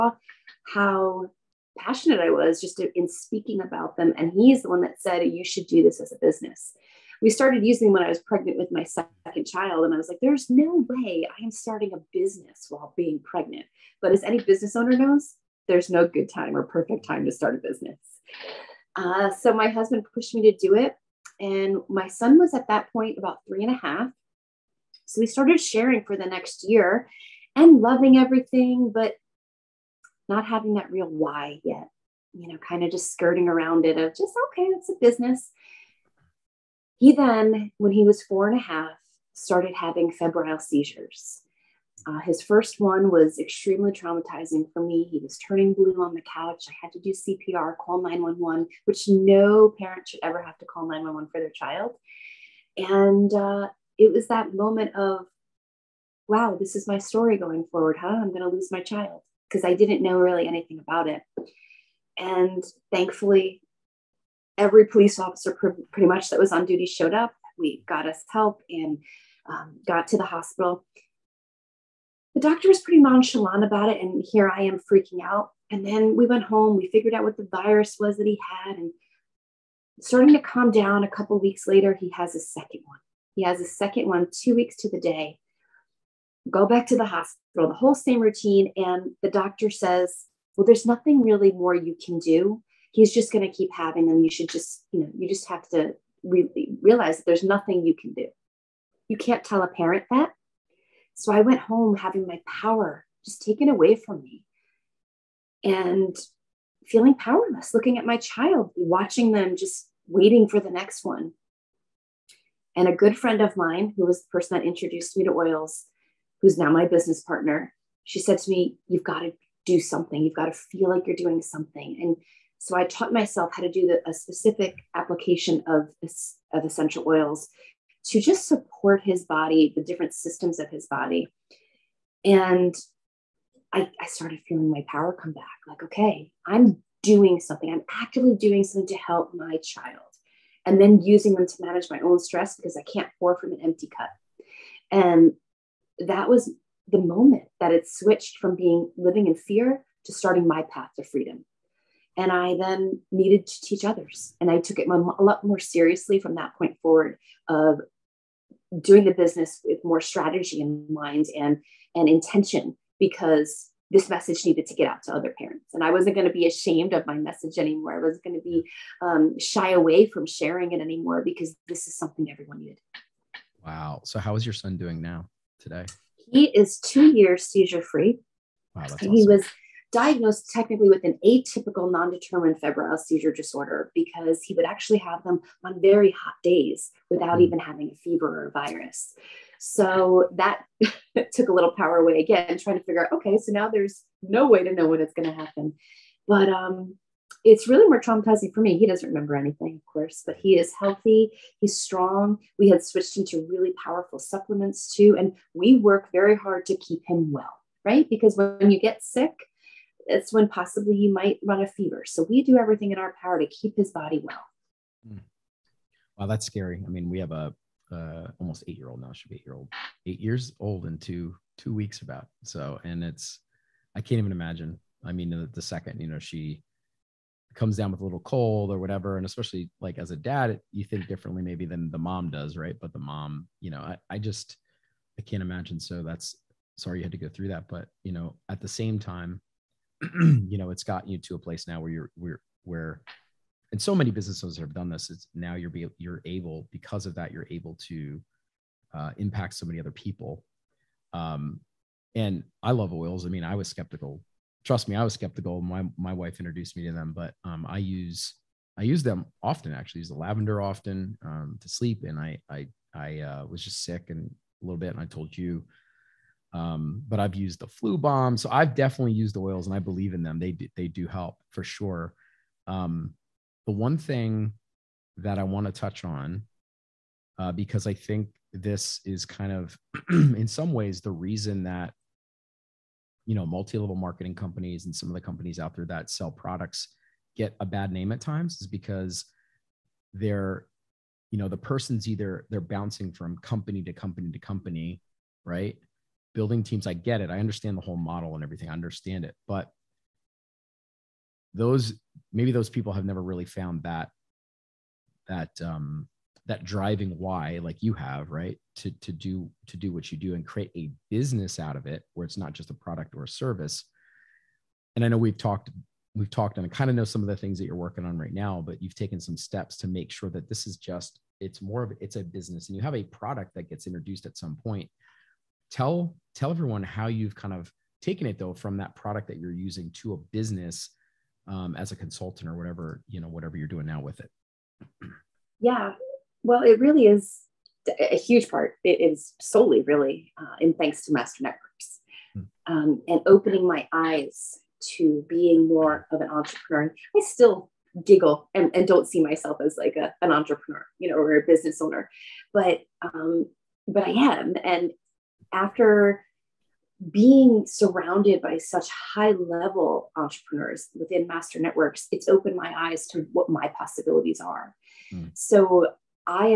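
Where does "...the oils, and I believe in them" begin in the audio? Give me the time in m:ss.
4:29.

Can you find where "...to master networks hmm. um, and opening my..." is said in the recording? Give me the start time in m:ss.
5:41.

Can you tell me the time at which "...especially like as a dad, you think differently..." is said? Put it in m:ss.
3:49.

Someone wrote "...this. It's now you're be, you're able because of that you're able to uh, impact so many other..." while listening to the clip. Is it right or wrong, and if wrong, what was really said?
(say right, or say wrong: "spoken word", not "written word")
right.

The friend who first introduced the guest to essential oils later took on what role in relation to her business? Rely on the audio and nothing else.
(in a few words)
Business partner.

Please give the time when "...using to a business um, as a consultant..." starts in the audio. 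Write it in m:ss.
5:29.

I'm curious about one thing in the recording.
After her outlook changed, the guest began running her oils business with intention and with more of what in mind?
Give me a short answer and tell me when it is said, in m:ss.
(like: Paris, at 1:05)
Strategy, at 2:40.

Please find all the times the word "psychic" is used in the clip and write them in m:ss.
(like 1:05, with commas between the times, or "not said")
not said.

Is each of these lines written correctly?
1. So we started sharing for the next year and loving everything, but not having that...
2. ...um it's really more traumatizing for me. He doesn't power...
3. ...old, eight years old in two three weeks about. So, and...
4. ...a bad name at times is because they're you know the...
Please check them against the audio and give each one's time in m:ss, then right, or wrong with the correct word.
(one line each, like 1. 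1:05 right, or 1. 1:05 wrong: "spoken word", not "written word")
1. 0:25 right
2. 3:16 wrong: "remember", not "power"
3. 3:39 wrong: "two", not "three"
4. 4:47 right.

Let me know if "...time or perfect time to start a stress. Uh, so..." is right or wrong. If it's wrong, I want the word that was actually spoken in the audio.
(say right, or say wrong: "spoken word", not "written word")
wrong: "business", not "stress".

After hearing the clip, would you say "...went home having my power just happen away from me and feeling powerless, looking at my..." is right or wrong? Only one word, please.
wrong.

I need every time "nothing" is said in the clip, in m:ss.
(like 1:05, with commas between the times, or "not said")
1:30, 1:37.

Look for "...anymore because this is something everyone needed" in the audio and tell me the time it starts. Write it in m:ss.
2:50.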